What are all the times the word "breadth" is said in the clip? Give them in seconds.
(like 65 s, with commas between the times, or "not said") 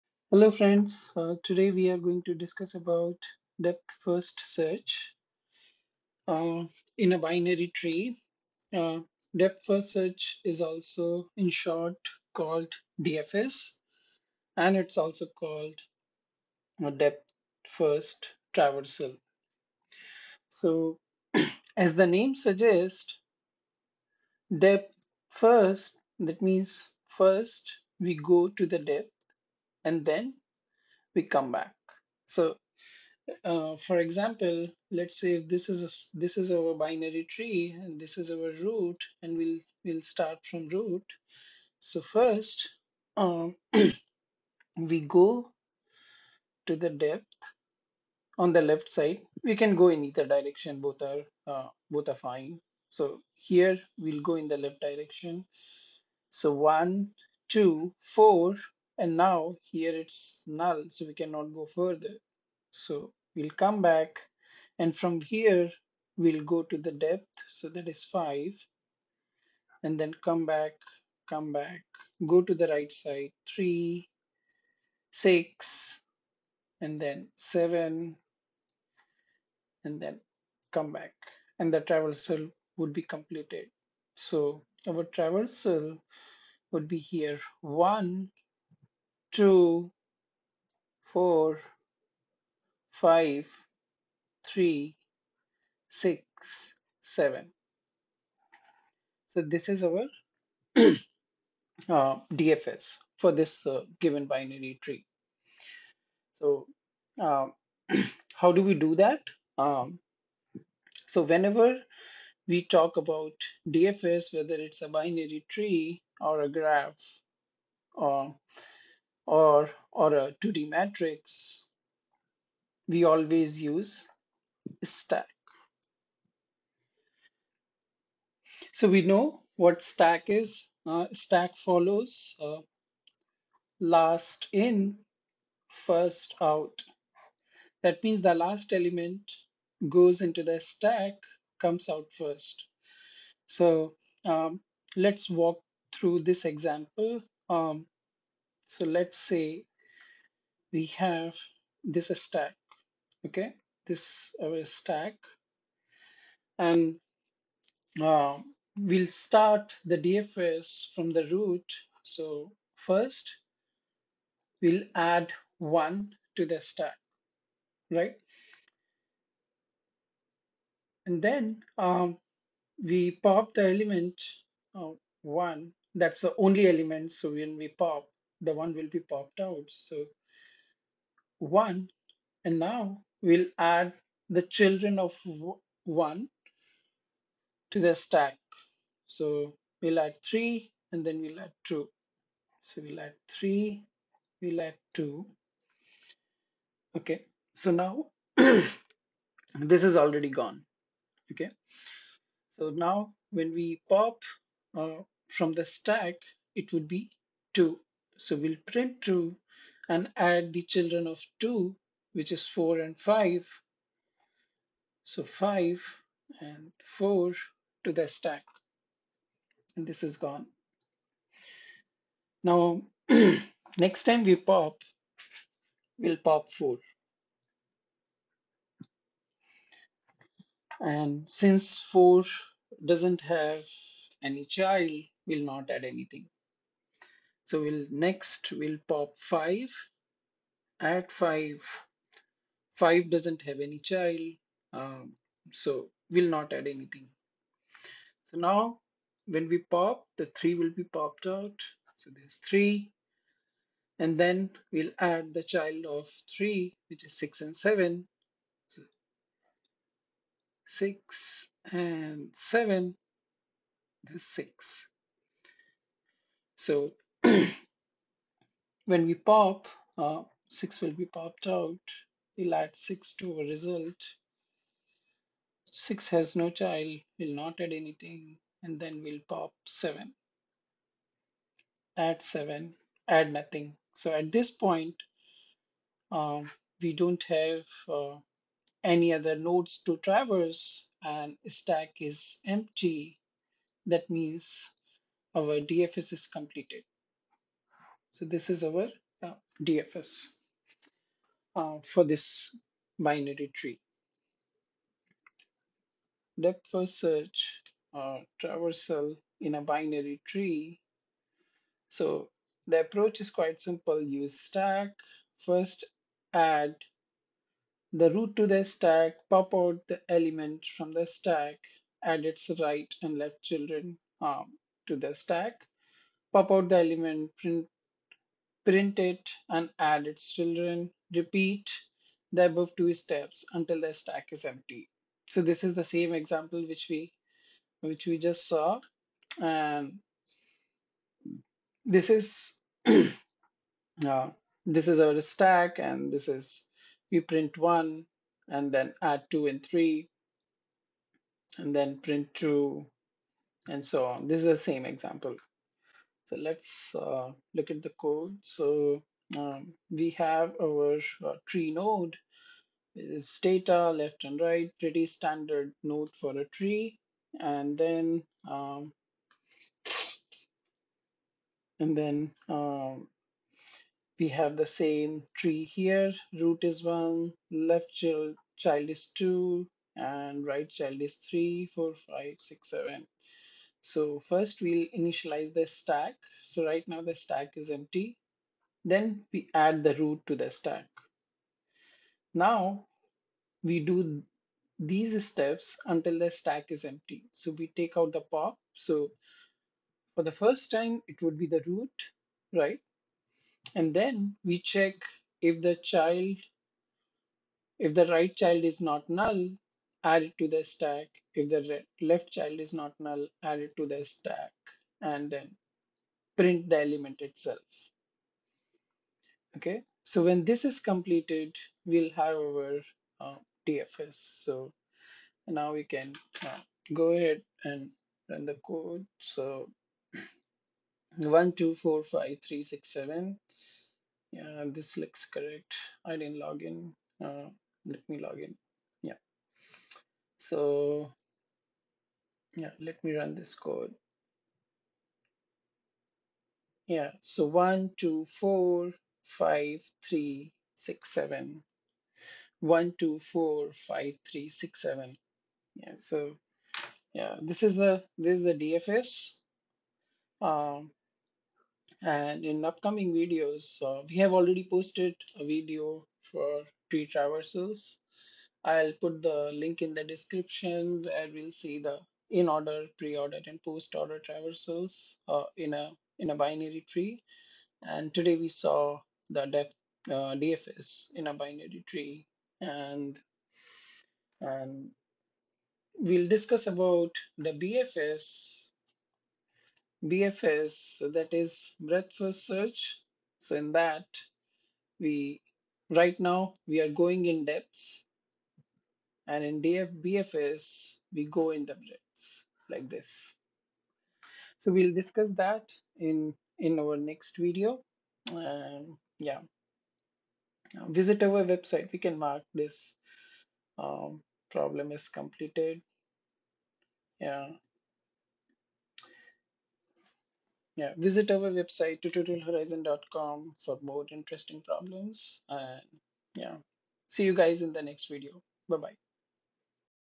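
491 s, 501 s.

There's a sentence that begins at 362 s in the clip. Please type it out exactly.
It's data left and right, pretty standard node for a tree.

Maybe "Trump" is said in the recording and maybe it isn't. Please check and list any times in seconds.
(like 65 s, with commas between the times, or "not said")
not said.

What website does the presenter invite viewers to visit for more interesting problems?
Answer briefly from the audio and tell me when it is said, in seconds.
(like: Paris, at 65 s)
tutorialhorizon.com, at 522 s.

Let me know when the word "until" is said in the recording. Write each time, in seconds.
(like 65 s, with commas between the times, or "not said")
333 s, 395 s.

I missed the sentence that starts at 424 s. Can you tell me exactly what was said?
So now we can uh, go ahead and run the code.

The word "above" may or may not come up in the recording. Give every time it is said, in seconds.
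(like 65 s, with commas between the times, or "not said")
332 s.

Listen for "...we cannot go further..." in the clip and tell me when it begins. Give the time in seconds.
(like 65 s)
61 s.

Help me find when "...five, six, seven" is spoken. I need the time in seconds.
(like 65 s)
382 s.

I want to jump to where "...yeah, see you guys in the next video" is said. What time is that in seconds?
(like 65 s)
526 s.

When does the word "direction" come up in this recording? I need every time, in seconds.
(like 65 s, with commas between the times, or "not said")
50 s, 54 s.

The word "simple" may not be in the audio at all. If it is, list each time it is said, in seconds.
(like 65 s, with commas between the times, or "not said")
313 s.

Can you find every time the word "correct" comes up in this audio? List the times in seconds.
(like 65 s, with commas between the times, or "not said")
435 s.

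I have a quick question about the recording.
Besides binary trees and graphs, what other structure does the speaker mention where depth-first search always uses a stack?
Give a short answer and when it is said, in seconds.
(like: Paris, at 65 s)
2D matrix, at 120 s.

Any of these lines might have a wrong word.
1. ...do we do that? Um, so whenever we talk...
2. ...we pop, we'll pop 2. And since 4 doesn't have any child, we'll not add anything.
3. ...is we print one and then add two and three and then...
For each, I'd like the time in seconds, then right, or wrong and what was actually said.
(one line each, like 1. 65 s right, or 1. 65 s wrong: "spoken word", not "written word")
1. 108 s right
2. 224 s wrong: "4", not "2"
3. 346 s right.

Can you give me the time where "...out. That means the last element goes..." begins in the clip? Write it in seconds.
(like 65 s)
136 s.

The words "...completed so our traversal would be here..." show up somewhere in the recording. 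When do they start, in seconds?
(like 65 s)
83 s.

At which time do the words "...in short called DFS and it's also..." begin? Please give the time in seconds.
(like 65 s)
11 s.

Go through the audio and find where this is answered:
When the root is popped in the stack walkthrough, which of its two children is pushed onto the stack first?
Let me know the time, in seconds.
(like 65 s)
189 s.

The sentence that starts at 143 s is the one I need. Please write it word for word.
So um, let's walk through this example.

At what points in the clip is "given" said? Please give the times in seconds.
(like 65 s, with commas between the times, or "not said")
104 s.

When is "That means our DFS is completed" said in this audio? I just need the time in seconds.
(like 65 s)
293 s.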